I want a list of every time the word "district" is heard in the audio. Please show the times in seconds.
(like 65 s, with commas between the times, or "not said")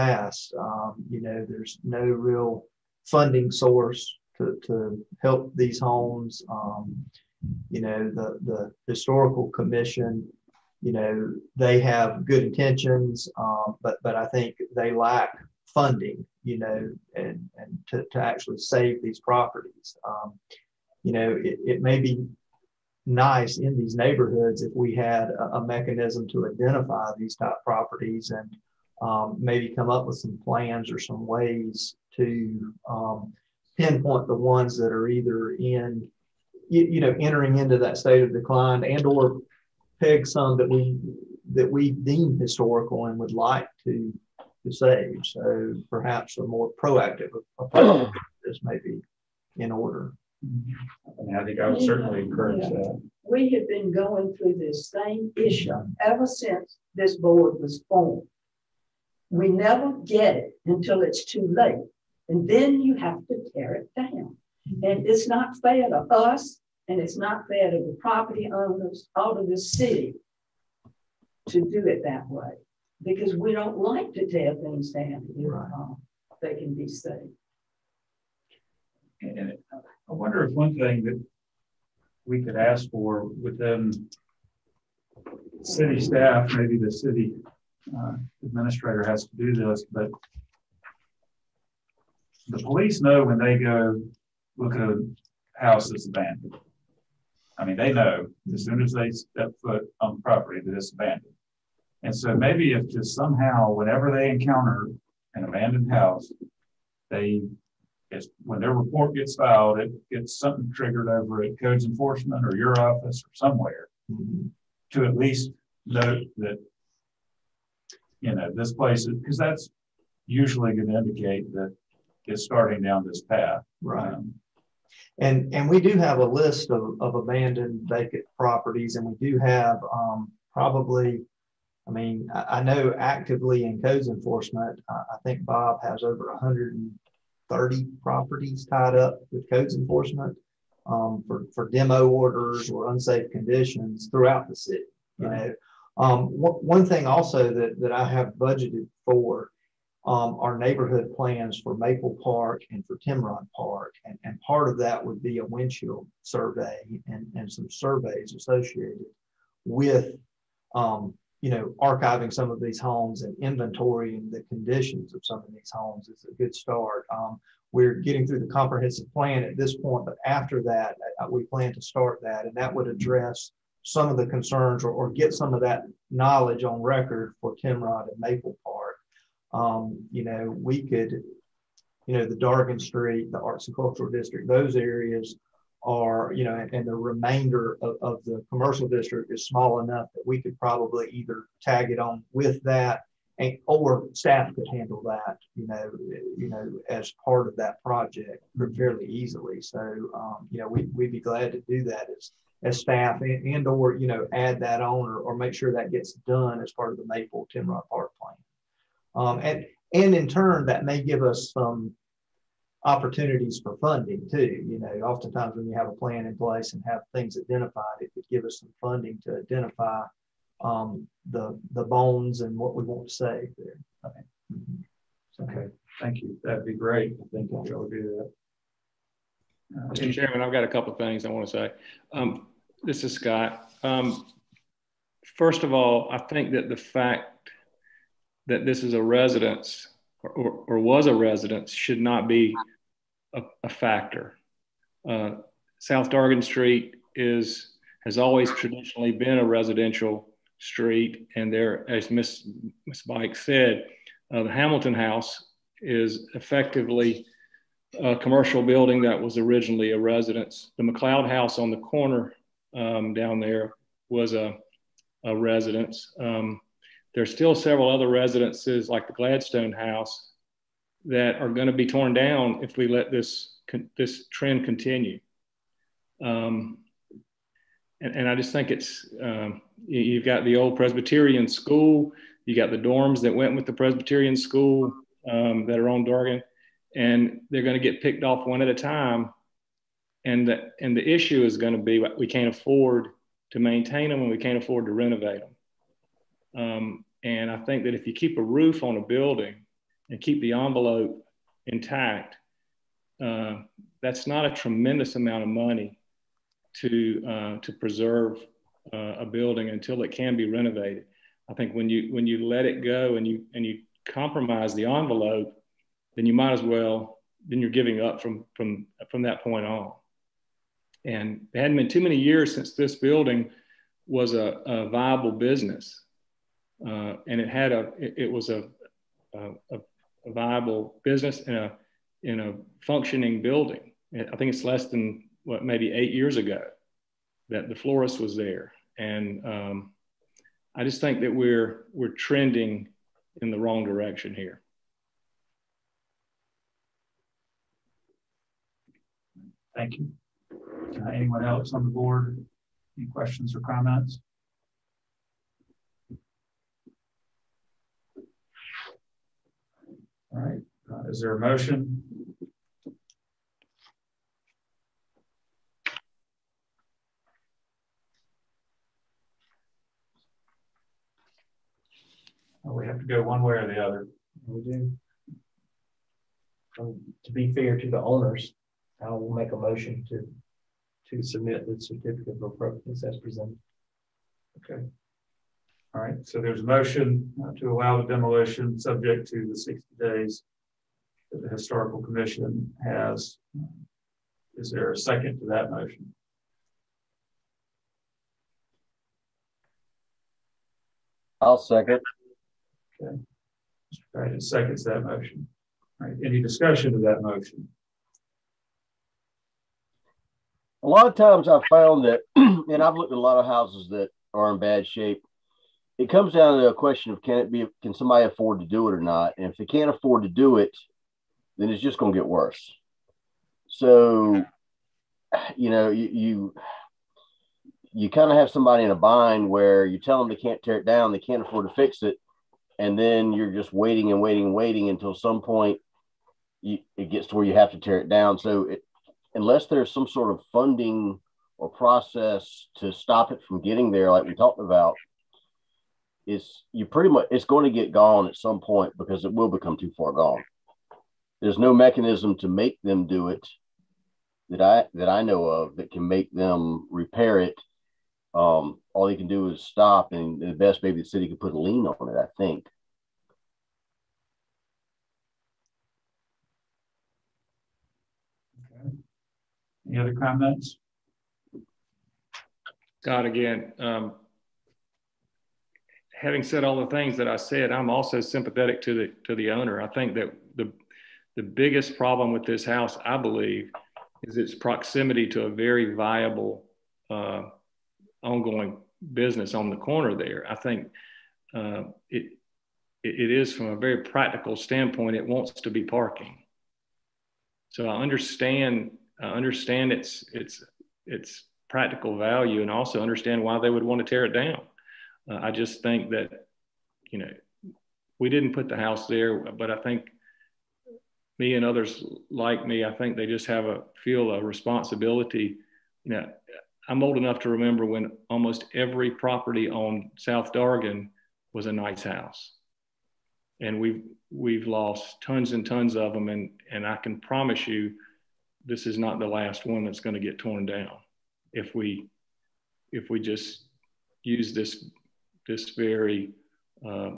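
184 s, 188 s.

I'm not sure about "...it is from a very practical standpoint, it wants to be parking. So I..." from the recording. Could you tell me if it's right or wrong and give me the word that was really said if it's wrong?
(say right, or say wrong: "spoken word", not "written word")
right.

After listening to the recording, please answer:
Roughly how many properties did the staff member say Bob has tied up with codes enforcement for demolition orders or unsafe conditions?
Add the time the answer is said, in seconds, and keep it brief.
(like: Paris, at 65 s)
130, at 136 s.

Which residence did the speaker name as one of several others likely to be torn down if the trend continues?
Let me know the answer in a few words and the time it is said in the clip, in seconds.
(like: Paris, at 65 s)
Gladstone House, at 269 s.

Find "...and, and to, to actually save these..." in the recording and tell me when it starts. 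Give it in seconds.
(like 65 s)
17 s.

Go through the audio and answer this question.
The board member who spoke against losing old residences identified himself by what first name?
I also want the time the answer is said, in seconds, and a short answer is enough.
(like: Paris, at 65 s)
Scott, at 233 s.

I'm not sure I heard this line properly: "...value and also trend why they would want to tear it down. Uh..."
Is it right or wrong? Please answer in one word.
wrong.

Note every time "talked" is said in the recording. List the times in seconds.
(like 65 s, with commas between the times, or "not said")
444 s.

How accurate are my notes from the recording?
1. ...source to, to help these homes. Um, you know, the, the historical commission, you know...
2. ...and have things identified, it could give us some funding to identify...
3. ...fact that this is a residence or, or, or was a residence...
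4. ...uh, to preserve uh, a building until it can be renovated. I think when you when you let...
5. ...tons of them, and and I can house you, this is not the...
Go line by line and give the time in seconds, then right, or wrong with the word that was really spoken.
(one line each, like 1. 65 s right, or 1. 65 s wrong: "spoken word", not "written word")
1. 3 s right
2. 216 s right
3. 236 s right
4. 307 s right
5. 525 s wrong: "promise", not "house".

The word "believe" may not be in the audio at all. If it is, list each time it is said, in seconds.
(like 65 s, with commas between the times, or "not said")
483 s.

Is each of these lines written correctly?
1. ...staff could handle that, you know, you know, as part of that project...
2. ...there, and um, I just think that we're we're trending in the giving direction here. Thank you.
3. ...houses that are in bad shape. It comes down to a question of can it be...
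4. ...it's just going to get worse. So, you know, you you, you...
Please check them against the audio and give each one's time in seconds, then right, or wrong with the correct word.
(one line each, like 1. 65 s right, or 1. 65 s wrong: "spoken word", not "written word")
1. 194 s right
2. 338 s wrong: "wrong", not "giving"
3. 413 s right
4. 421 s right.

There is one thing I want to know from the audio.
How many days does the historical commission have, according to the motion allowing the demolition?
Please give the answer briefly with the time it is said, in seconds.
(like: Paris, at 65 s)
60, at 389 s.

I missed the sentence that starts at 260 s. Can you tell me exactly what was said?
The McLeod House on the corner um, down there was a, a residence.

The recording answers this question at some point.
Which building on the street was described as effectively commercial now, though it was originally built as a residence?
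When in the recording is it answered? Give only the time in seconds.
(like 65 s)
254 s.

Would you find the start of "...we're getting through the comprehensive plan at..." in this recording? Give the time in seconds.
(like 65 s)
167 s.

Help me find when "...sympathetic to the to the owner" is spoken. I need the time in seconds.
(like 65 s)
478 s.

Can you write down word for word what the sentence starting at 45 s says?
So perhaps a more proactive approach is maybe in order.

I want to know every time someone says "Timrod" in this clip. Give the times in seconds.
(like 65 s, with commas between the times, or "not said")
153 s, 177 s, 207 s.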